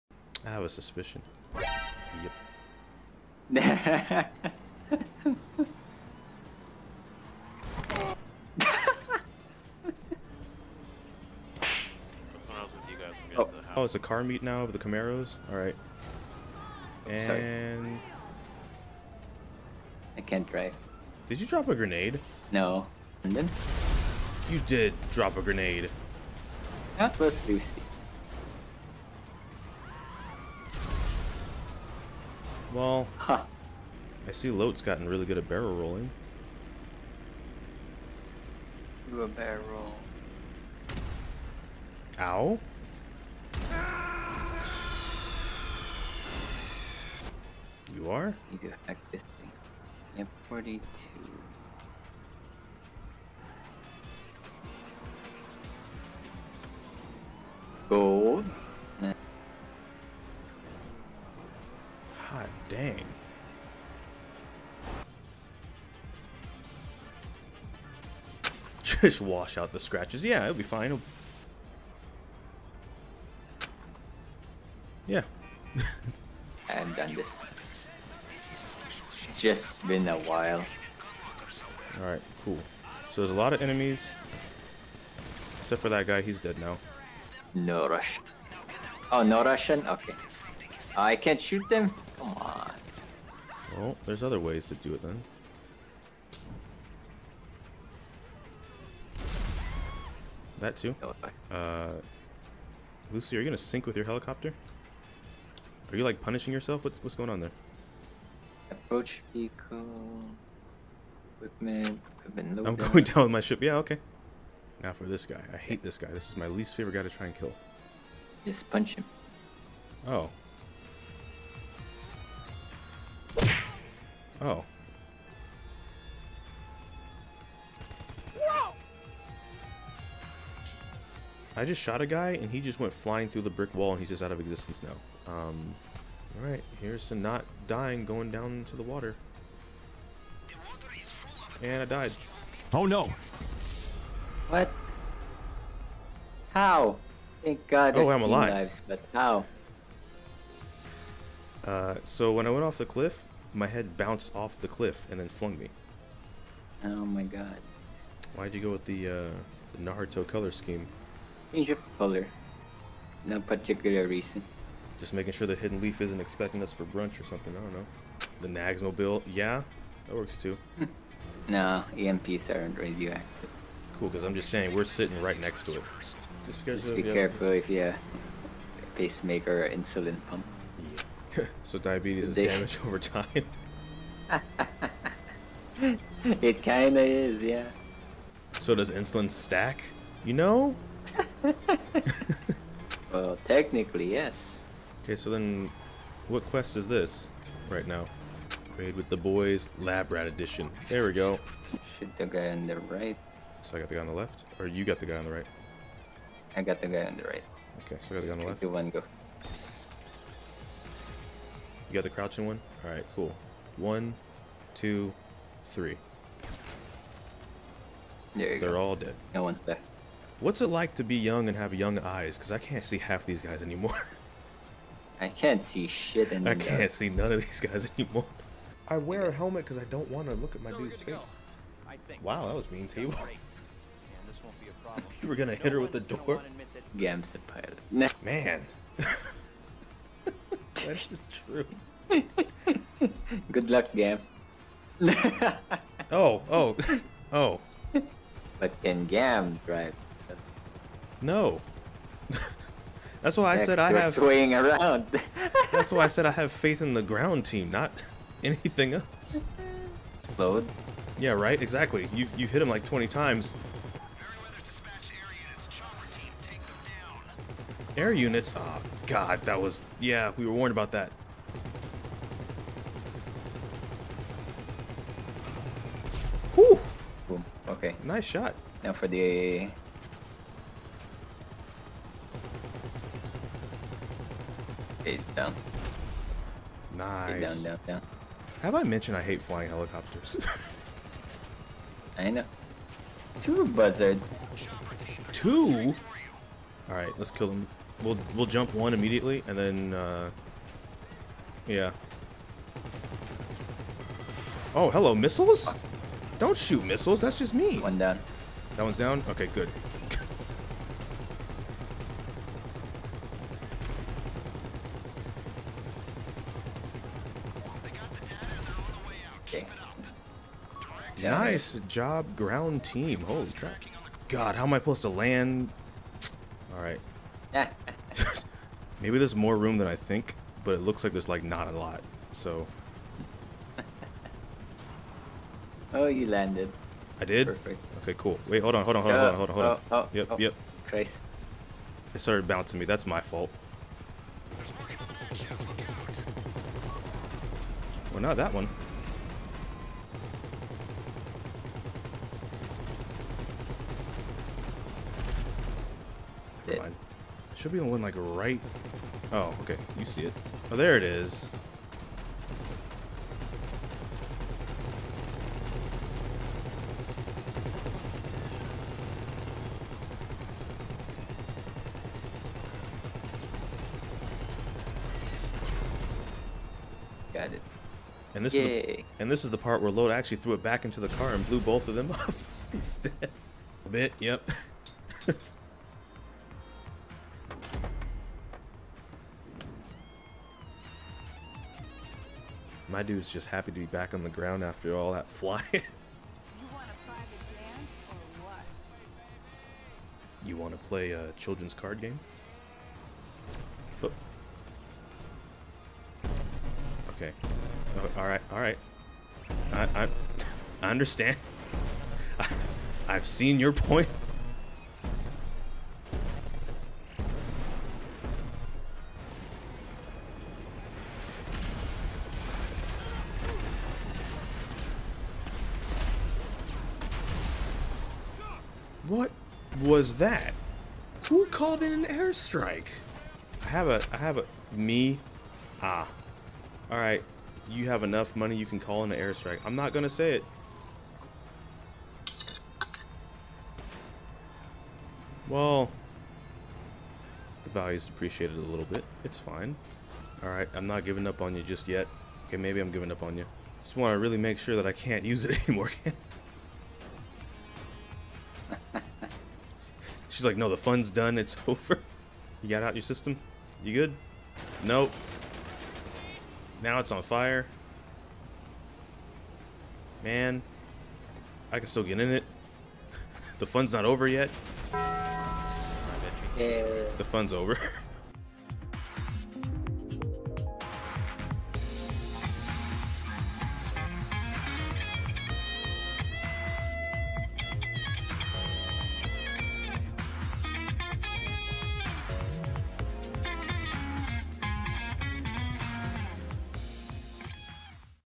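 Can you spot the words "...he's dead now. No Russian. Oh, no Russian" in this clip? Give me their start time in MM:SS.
01:26.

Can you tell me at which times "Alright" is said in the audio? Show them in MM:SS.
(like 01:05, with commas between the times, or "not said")
00:15, 01:22, 02:16, 03:32, 04:56, 05:26, 07:16, 07:30.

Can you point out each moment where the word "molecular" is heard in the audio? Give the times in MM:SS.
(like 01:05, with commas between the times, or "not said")
not said.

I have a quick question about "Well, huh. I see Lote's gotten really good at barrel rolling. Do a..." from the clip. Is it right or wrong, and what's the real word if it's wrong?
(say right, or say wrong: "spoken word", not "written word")
right.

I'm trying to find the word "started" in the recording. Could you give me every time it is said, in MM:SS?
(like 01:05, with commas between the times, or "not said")
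05:42.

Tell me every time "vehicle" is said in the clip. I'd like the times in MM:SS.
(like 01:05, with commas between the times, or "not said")
01:49.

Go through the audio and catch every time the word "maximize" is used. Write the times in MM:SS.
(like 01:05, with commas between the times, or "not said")
not said.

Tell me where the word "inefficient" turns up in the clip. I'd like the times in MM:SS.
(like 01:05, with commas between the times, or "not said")
not said.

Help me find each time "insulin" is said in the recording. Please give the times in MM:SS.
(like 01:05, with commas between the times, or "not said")
02:59, 03:08.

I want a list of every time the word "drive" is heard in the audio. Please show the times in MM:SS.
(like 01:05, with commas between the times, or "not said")
00:20, 04:09.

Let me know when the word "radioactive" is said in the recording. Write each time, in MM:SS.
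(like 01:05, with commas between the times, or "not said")
02:52.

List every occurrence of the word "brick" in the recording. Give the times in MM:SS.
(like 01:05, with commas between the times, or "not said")
02:13.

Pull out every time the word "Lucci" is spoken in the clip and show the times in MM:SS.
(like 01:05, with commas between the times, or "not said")
00:27, 01:43.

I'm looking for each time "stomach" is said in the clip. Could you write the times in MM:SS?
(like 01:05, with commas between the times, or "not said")
not said.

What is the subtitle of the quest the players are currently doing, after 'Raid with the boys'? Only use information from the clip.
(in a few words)
lab rat edition.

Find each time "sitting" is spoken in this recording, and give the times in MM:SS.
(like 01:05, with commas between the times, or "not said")
02:54.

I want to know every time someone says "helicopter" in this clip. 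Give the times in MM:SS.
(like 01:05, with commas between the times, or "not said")
01:44, 04:49.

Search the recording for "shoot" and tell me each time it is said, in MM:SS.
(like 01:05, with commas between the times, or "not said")
01:31, 03:21, 05:06.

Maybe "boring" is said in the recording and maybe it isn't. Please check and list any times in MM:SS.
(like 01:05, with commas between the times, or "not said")
not said.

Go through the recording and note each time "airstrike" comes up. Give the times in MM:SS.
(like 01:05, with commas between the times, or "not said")
07:12, 07:19.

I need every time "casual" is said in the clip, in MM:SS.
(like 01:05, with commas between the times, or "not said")
not said.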